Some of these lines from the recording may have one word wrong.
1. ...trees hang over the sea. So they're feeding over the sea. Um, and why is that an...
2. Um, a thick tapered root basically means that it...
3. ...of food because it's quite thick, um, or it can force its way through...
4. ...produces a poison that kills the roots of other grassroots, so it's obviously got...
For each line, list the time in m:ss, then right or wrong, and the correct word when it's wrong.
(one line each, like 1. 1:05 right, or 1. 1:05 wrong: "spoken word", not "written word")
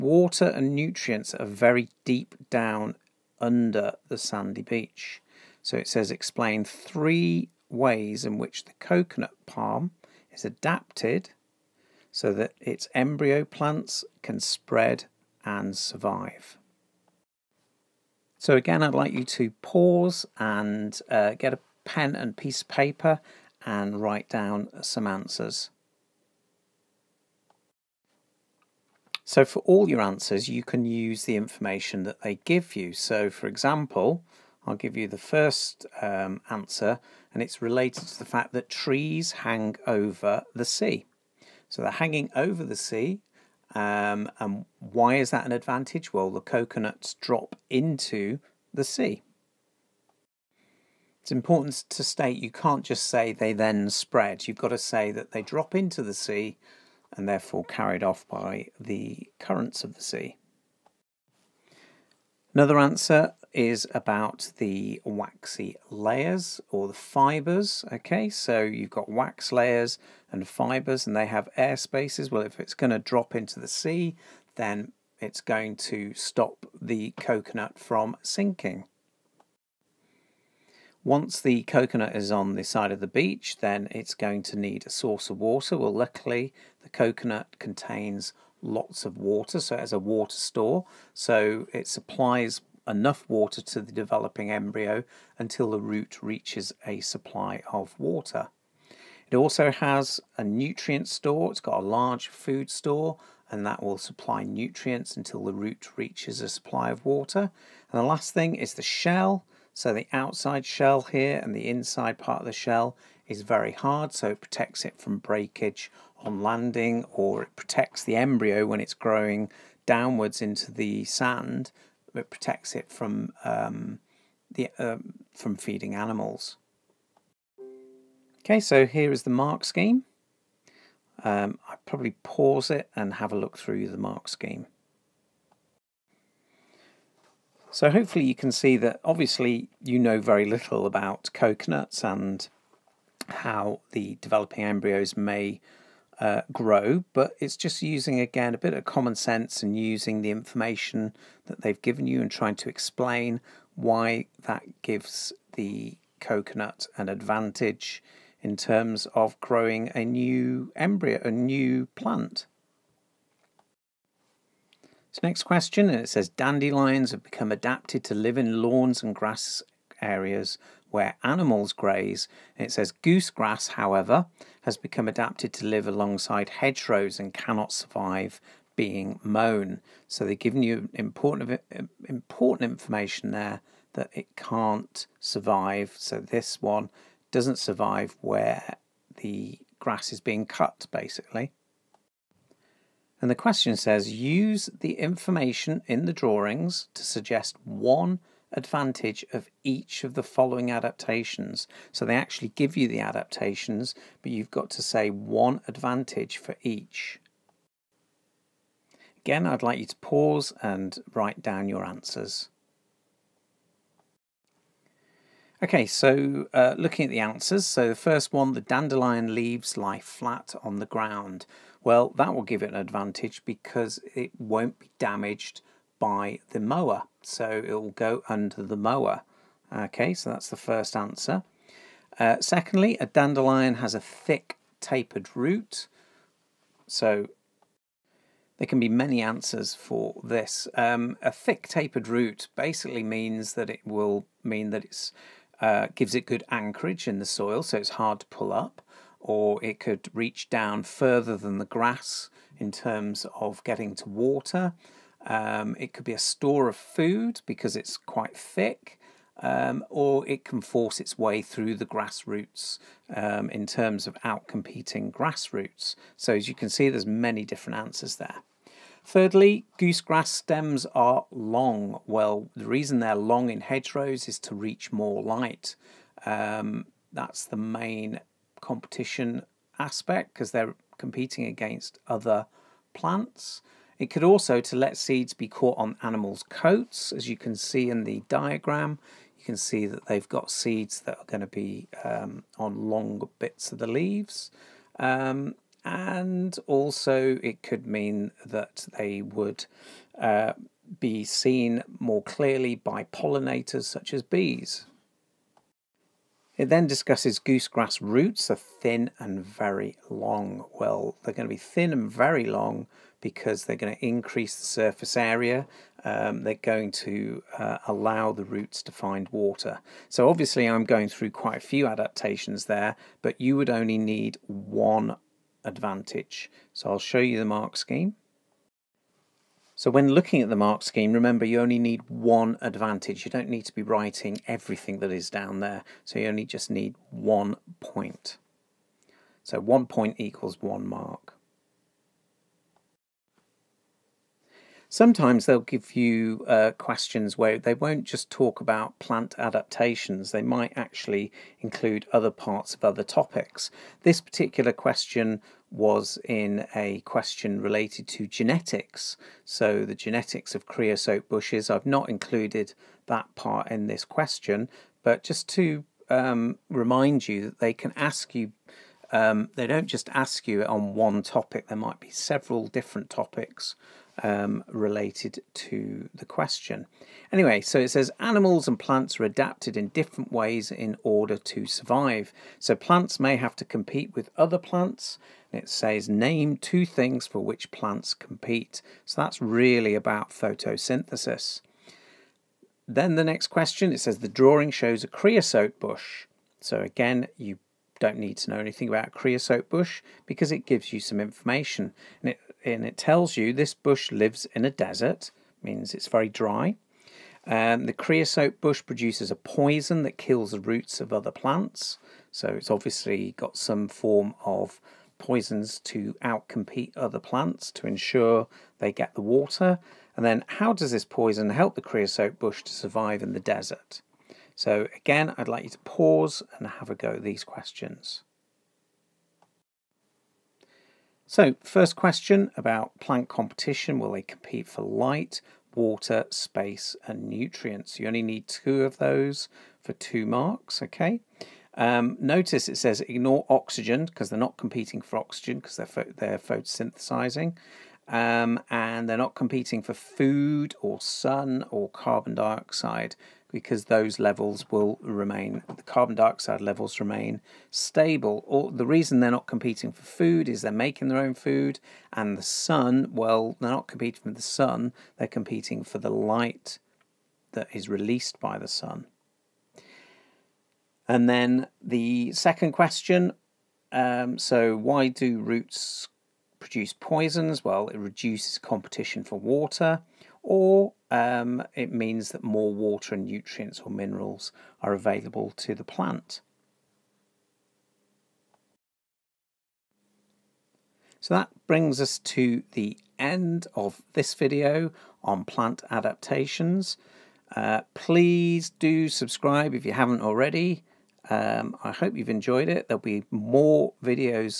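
1. 0:38 wrong: "hanging", not "feeding"
2. 4:00 right
3. 4:16 right
4. 6:48 wrong: "plants", not "grassroots".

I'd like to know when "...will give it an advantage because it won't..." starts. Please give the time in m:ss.
3:42.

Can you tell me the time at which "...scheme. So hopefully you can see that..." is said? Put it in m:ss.
2:14.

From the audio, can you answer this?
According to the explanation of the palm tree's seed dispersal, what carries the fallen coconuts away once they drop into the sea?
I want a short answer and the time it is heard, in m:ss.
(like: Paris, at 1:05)
Currents of the sea, at 0:59.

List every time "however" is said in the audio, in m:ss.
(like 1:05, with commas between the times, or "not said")
2:53.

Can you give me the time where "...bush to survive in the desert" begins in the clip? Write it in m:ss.
7:02.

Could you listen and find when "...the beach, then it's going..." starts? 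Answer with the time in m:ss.
1:22.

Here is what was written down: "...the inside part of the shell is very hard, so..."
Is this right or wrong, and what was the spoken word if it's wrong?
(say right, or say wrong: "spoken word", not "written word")
right.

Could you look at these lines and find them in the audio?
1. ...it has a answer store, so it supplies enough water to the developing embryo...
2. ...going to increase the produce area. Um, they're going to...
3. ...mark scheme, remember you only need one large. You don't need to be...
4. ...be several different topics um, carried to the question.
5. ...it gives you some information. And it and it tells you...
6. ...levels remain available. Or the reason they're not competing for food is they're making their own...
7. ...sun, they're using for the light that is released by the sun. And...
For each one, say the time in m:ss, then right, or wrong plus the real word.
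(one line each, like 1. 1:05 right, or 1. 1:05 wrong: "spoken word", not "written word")
1. 1:29 wrong: "water", not "answer"
2. 5:13 wrong: "surface", not "produce"
3. 5:30 wrong: "advantage", not "large"
4. 6:11 wrong: "related", not "carried"
5. 6:40 right
6. 7:36 wrong: "stable", not "available"
7. 7:44 wrong: "competing", not "using".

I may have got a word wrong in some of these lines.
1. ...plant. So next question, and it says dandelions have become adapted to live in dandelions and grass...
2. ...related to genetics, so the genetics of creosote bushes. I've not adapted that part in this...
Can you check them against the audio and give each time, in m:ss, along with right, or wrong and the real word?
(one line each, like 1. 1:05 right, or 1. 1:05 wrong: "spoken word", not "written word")
1. 2:41 wrong: "lawns", not "dandelions"
2. 5:57 wrong: "included", not "adapted".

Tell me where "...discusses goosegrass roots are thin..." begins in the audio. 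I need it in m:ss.
5:06.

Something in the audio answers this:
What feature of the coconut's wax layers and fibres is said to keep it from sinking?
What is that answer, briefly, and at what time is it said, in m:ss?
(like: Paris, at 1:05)
Air spaces, at 1:11.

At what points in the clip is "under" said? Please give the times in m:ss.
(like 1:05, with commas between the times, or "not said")
0:03, 3:48.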